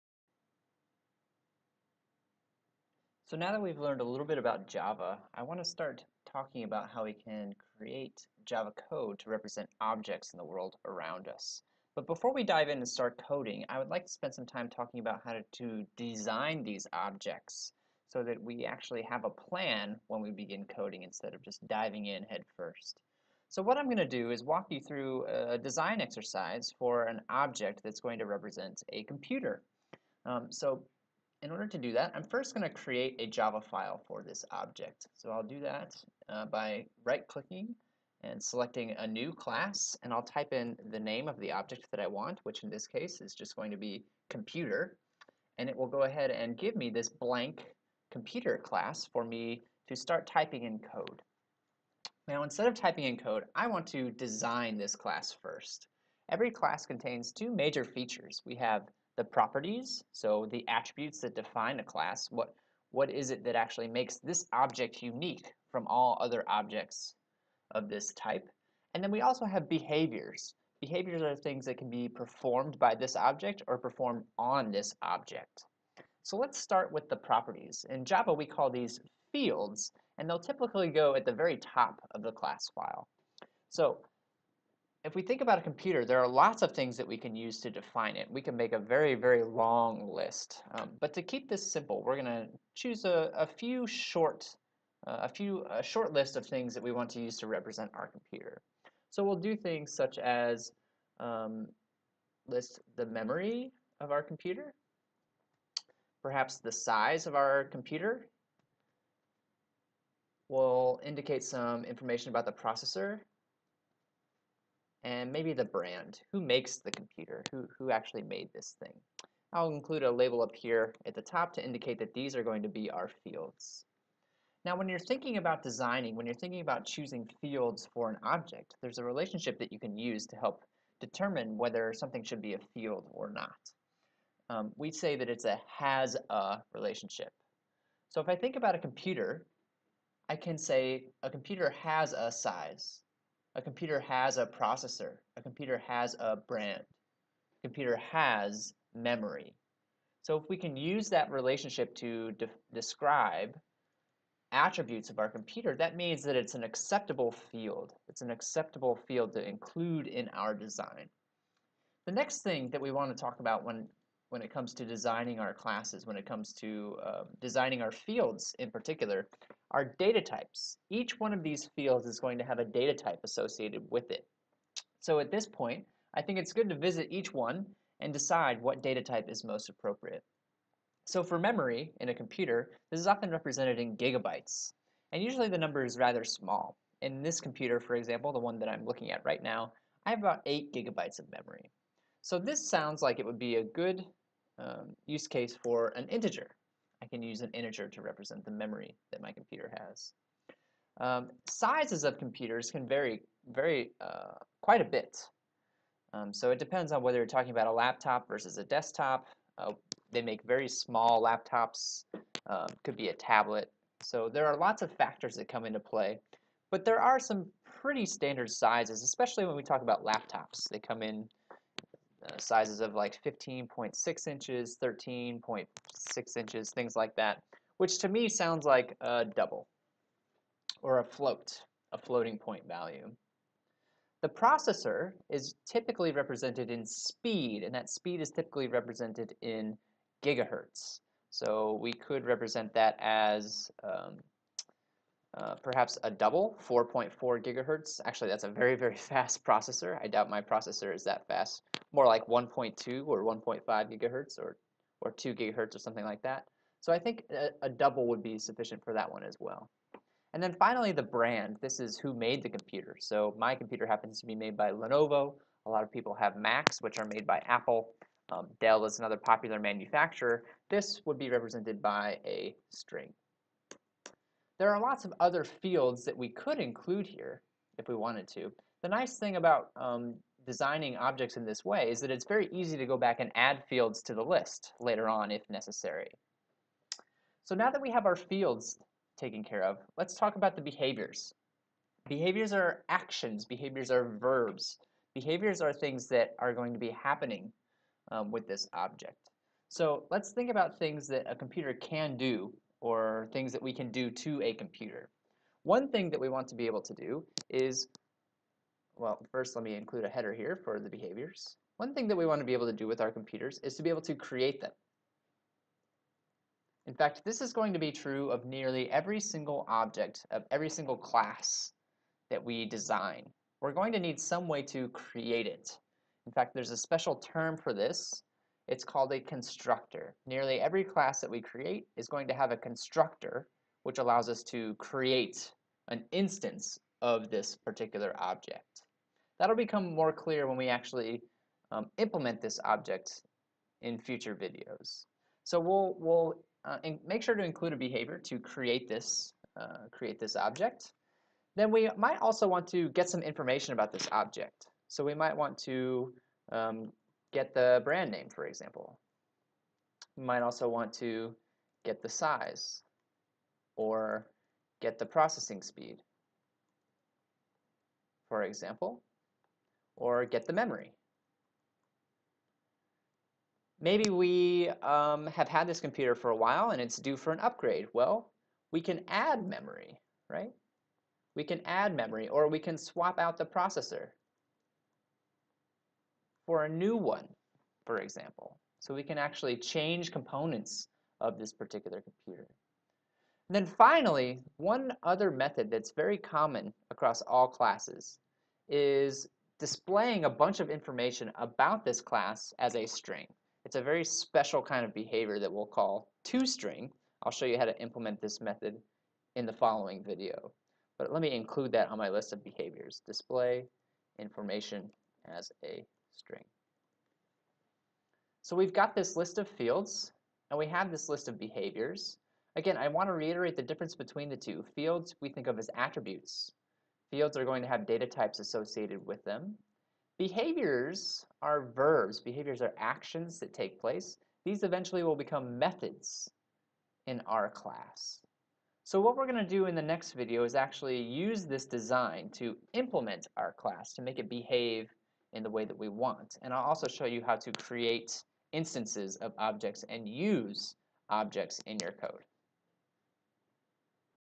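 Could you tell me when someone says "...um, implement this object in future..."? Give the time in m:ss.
5:41.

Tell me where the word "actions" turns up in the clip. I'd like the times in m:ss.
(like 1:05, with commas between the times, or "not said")
4:52, 7:12.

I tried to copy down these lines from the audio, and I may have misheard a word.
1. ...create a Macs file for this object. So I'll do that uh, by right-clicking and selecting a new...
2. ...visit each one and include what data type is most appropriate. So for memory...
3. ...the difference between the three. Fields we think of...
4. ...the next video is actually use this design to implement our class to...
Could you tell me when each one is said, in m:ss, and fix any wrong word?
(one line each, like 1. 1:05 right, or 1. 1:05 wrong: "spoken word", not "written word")
1. 0:32 wrong: "Java", not "Macs"
2. 2:56 wrong: "decide", not "include"
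3. 7:03 wrong: "two", not "three"
4. 7:19 right.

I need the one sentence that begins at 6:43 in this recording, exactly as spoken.
It's a very special kind of behavior that we'll call toString.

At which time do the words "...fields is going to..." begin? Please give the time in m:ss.
2:51.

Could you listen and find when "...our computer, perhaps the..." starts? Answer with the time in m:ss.
1:44.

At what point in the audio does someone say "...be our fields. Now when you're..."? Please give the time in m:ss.
2:02.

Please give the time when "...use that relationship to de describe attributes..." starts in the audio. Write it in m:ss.
2:30.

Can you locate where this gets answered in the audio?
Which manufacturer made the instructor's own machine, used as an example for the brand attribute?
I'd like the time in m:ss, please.
4:24.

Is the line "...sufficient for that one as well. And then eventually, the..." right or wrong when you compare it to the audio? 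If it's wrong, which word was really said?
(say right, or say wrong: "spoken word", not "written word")
wrong: "finally", not "eventually".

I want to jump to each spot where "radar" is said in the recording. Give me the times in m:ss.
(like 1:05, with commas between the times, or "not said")
not said.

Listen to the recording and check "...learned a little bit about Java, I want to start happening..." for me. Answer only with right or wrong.
wrong.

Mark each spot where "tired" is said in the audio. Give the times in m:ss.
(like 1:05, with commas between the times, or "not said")
not said.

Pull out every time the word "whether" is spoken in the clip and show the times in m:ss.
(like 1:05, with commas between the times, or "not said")
2:11, 3:27.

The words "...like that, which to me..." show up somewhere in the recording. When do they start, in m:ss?
3:46.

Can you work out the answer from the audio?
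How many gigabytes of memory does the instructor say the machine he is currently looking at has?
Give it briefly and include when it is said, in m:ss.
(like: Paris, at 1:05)
8, at 3:10.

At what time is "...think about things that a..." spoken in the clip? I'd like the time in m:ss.
5:00.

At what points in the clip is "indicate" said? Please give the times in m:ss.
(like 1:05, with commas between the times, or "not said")
1:51, 2:01.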